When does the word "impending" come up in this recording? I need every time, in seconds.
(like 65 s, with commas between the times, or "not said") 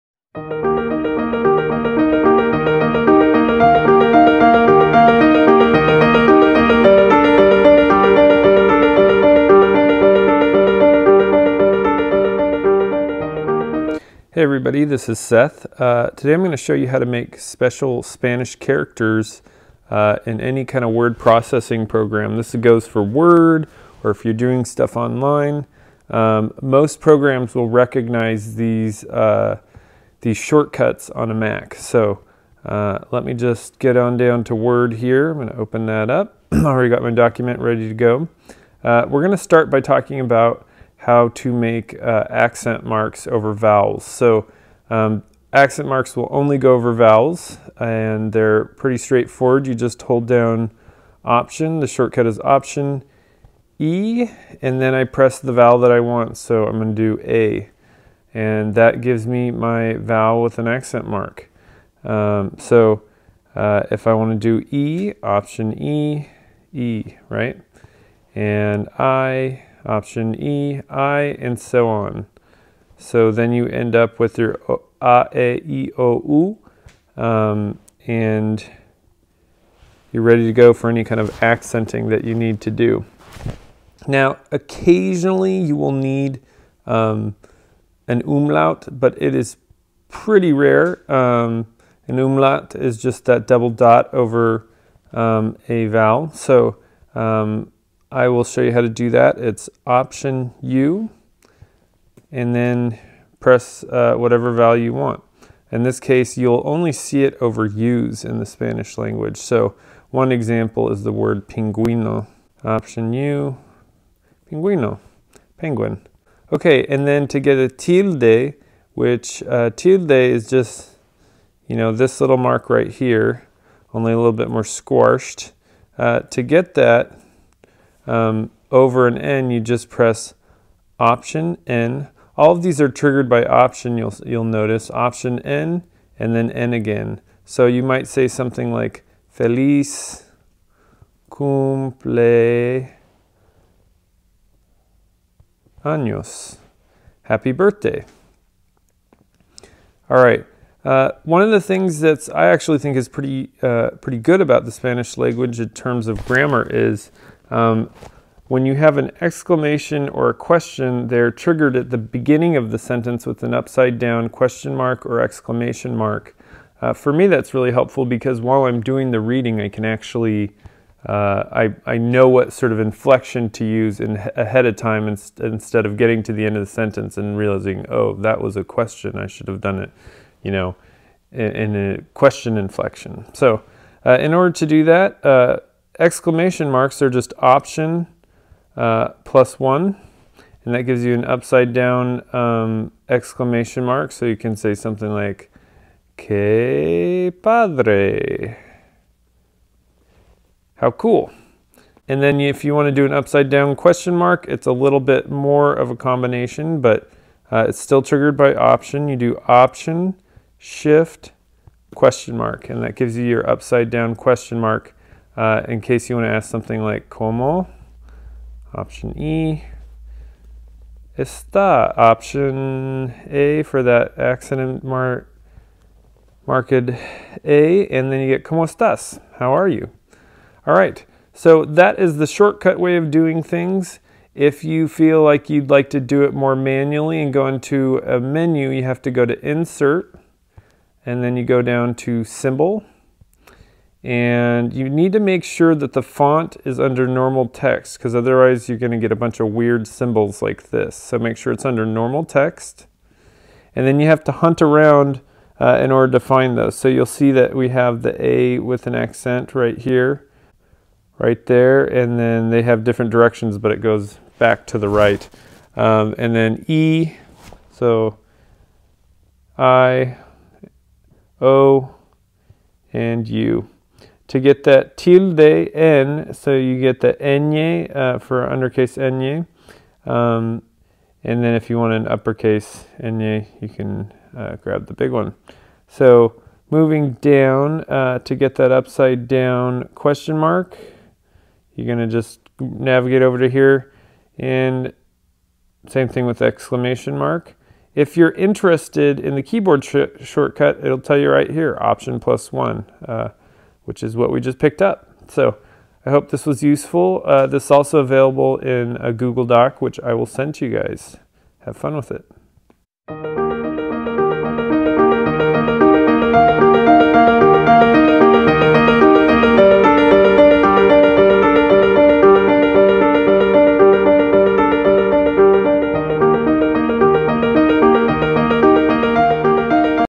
not said.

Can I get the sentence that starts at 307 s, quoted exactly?
Uh, this is also available in a Google Doc, which I will send to you guys.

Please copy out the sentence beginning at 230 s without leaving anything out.
All right, so that is the shortcut way of doing things.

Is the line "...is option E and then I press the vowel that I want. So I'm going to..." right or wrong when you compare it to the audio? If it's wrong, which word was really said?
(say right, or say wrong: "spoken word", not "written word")
right.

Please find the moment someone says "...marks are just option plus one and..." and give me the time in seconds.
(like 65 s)
186 s.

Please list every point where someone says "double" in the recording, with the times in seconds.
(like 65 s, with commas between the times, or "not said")
93 s.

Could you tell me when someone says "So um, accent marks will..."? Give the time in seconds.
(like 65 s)
44 s.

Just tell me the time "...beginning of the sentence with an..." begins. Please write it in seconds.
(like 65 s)
161 s.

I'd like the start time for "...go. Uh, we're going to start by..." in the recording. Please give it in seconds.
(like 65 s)
37 s.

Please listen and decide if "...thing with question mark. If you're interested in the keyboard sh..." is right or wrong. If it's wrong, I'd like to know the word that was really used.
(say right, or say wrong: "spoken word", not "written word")
wrong: "exclamation", not "question".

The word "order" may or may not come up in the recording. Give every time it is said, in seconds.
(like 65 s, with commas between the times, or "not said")
184 s, 255 s.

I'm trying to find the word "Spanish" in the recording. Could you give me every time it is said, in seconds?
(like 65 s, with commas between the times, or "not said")
18 s, 108 s, 154 s.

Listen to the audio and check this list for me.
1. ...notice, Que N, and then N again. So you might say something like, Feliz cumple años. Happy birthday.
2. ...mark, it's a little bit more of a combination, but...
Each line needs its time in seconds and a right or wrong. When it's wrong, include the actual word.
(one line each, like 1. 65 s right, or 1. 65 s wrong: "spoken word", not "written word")
1. 134 s wrong: "Option", not "Que"
2. 204 s right.